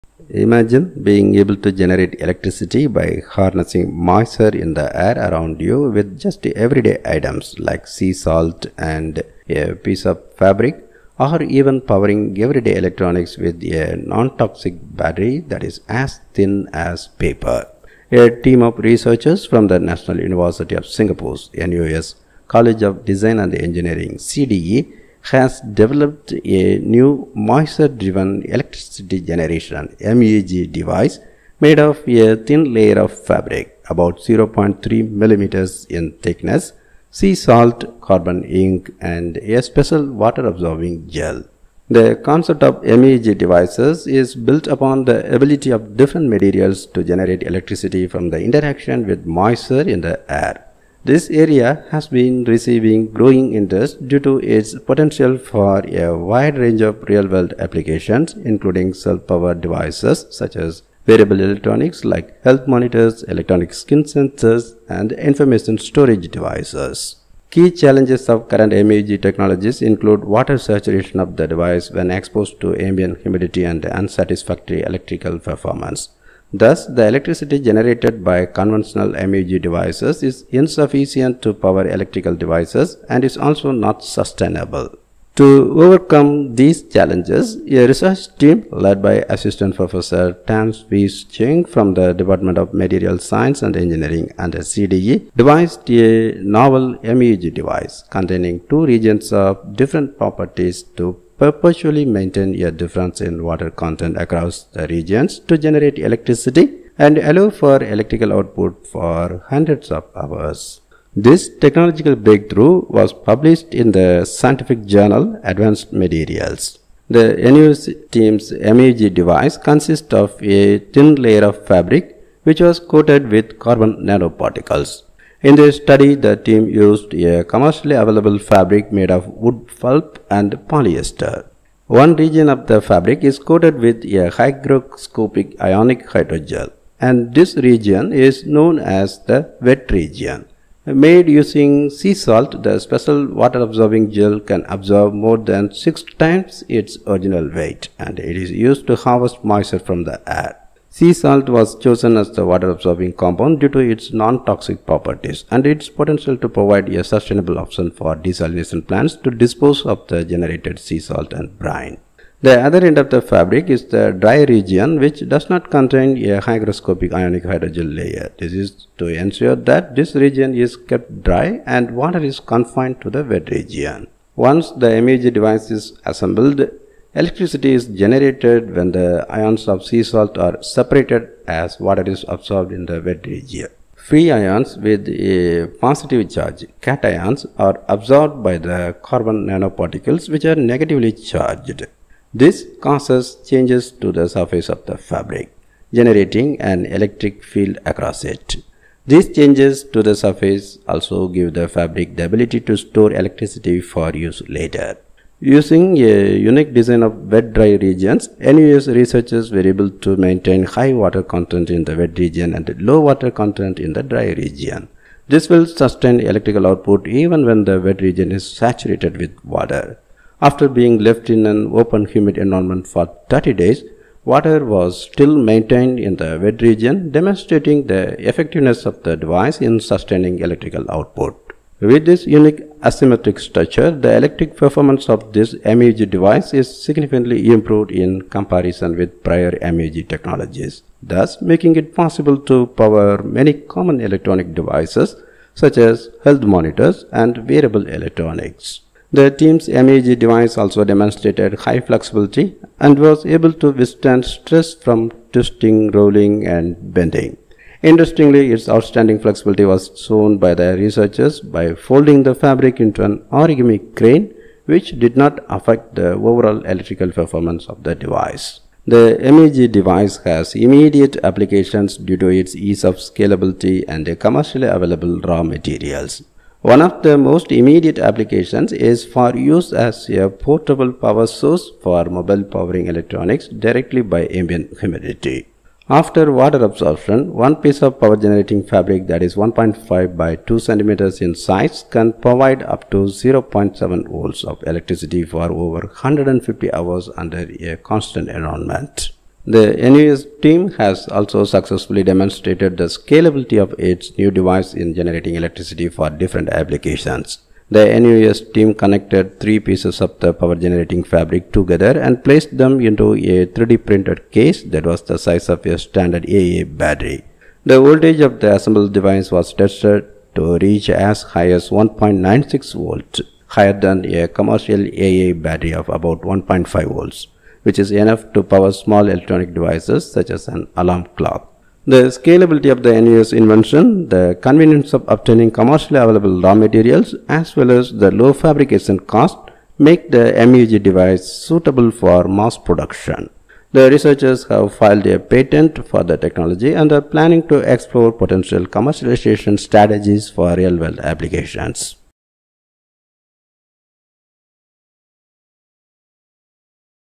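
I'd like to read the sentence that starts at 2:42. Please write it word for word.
The other end of the fabric is the dry region which does not contain a hygroscopic ionic hydrogel layer.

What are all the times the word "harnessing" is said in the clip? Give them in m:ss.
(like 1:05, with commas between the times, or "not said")
0:03.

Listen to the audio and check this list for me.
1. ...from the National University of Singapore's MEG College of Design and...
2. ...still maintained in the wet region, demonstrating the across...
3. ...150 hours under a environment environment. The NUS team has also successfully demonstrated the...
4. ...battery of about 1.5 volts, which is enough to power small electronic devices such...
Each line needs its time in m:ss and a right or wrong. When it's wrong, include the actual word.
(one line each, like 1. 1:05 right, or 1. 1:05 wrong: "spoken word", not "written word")
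1. 0:19 wrong: "NUS", not "MEG"
2. 3:45 wrong: "effectiveness", not "across"
3. 4:55 wrong: "constant", not "environment"
4. 5:25 right.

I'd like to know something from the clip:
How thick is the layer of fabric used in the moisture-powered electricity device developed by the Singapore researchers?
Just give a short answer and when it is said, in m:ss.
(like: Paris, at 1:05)
0.3 millimeters, at 0:34.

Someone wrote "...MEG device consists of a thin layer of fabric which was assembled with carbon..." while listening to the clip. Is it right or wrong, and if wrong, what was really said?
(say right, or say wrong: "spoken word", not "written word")
wrong: "coated", not "assembled".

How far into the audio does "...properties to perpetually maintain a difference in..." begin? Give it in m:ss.
1:40.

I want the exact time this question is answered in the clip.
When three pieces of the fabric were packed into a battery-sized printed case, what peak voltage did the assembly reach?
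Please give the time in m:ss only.
5:21.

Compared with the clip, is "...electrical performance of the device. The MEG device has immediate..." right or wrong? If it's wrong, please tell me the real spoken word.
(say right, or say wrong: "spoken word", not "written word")
right.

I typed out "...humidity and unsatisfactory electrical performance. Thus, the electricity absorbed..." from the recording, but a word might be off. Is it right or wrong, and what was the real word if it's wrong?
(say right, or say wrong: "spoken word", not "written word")
wrong: "generated", not "absorbed".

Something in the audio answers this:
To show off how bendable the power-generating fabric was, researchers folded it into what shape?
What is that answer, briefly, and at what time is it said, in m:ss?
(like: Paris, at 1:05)
origami crane, at 4:23.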